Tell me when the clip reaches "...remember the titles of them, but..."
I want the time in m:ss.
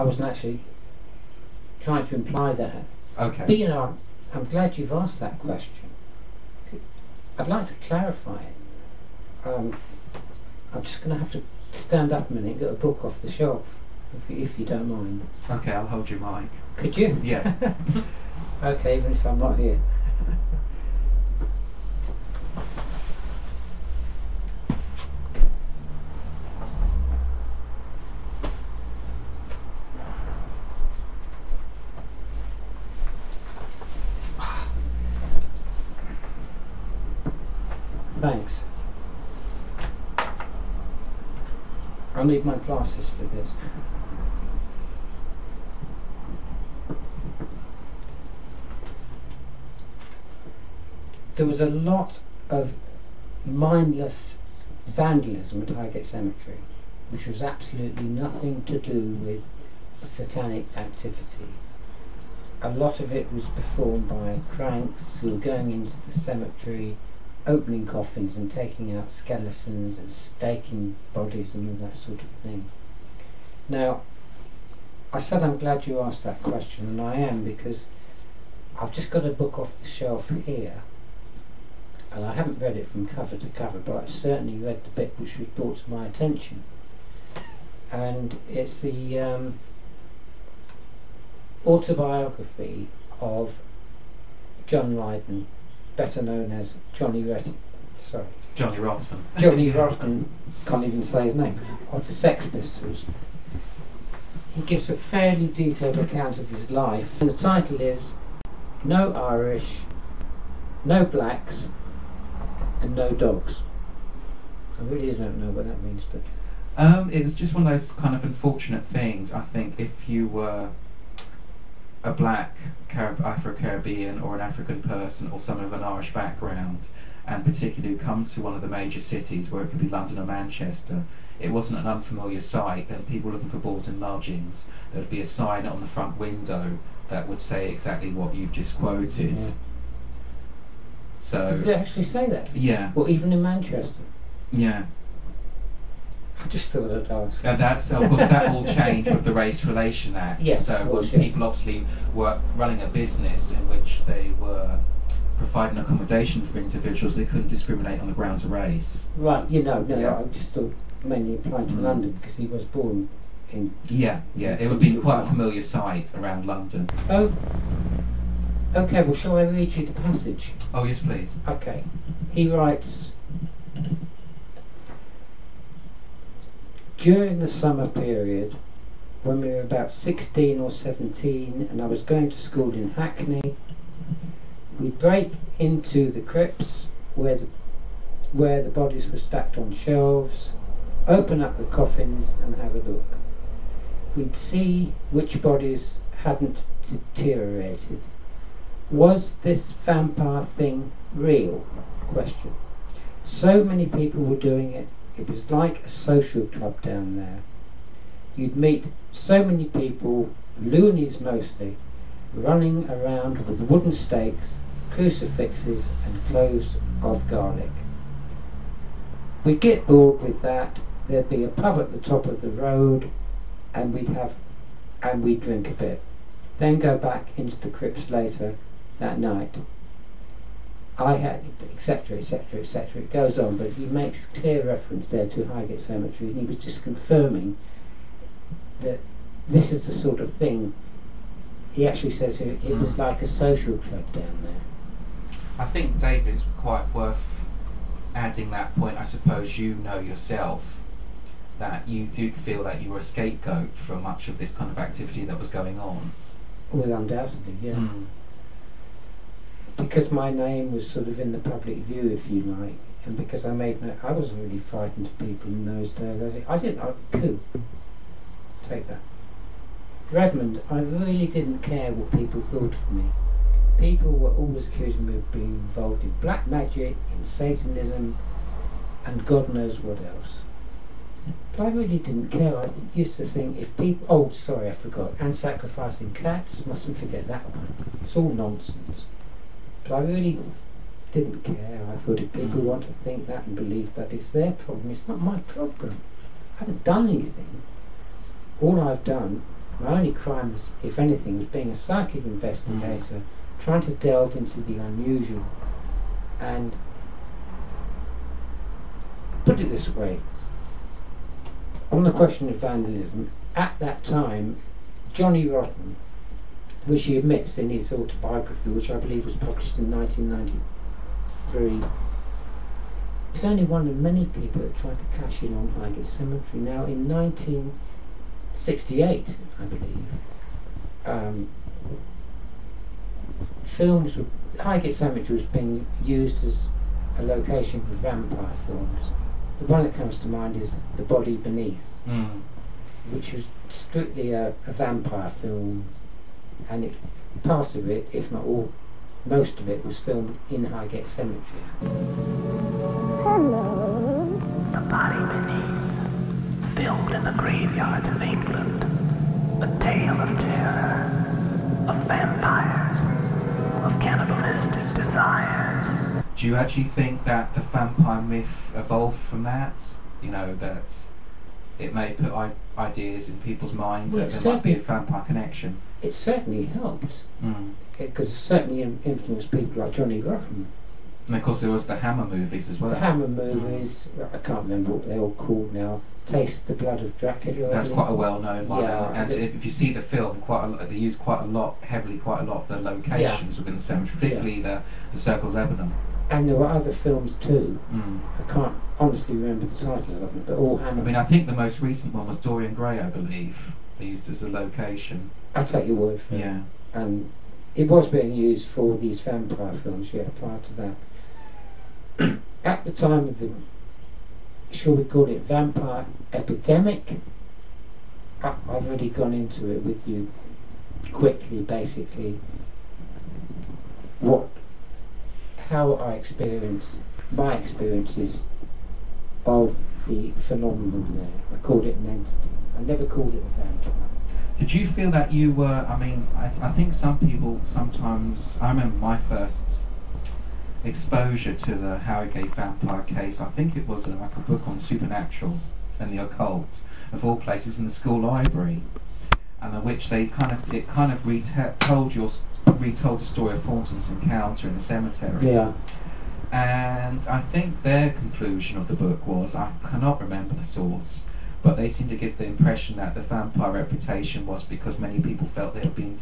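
6:39.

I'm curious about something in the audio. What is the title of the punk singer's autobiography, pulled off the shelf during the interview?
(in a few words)
No Irish, No Blacks, and No Dogs.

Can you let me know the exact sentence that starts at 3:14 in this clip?
We'd see which bodies hadn't deteriorated.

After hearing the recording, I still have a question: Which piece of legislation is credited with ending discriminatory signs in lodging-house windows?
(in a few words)
Race Relation Act.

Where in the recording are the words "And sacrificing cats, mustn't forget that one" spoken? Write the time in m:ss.
4:45.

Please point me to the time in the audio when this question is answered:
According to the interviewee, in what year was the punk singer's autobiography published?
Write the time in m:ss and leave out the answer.
5:19.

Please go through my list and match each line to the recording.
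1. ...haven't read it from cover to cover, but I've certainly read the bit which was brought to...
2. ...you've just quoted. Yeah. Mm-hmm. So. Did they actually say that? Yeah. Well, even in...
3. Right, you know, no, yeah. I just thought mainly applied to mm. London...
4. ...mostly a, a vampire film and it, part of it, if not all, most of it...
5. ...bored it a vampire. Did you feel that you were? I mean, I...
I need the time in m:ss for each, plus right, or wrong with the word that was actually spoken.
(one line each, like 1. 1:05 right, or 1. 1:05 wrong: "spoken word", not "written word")
1. 1:22 right
2. 2:18 right
3. 2:39 right
4. 5:43 wrong: "strictly", not "mostly"
5. 7:13 wrong: "called", not "bored".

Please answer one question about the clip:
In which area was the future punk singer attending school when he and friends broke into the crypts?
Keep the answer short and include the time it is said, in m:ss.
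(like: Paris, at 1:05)
Hackney, at 3:02.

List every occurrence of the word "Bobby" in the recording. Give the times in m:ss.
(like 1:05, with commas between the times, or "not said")
not said.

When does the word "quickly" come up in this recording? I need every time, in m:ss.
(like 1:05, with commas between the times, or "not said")
7:01.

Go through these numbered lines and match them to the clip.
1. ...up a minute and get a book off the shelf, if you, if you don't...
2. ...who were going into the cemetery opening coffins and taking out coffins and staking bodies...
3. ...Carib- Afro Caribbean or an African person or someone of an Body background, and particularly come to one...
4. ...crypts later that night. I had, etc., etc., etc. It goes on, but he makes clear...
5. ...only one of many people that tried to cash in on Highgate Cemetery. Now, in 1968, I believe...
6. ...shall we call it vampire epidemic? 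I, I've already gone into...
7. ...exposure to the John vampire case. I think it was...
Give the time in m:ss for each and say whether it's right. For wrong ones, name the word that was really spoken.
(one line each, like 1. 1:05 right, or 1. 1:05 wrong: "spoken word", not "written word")
1. 0:12 right
2. 1:05 wrong: "skeletons", not "coffins"
3. 2:02 wrong: "Irish", not "Body"
4. 3:47 right
5. 5:23 right
6. 6:54 right
7. 7:20 wrong: "Highgate", not "John".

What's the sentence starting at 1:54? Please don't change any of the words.
I really don't know what that means, but.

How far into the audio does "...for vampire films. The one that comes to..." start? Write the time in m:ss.
5:37.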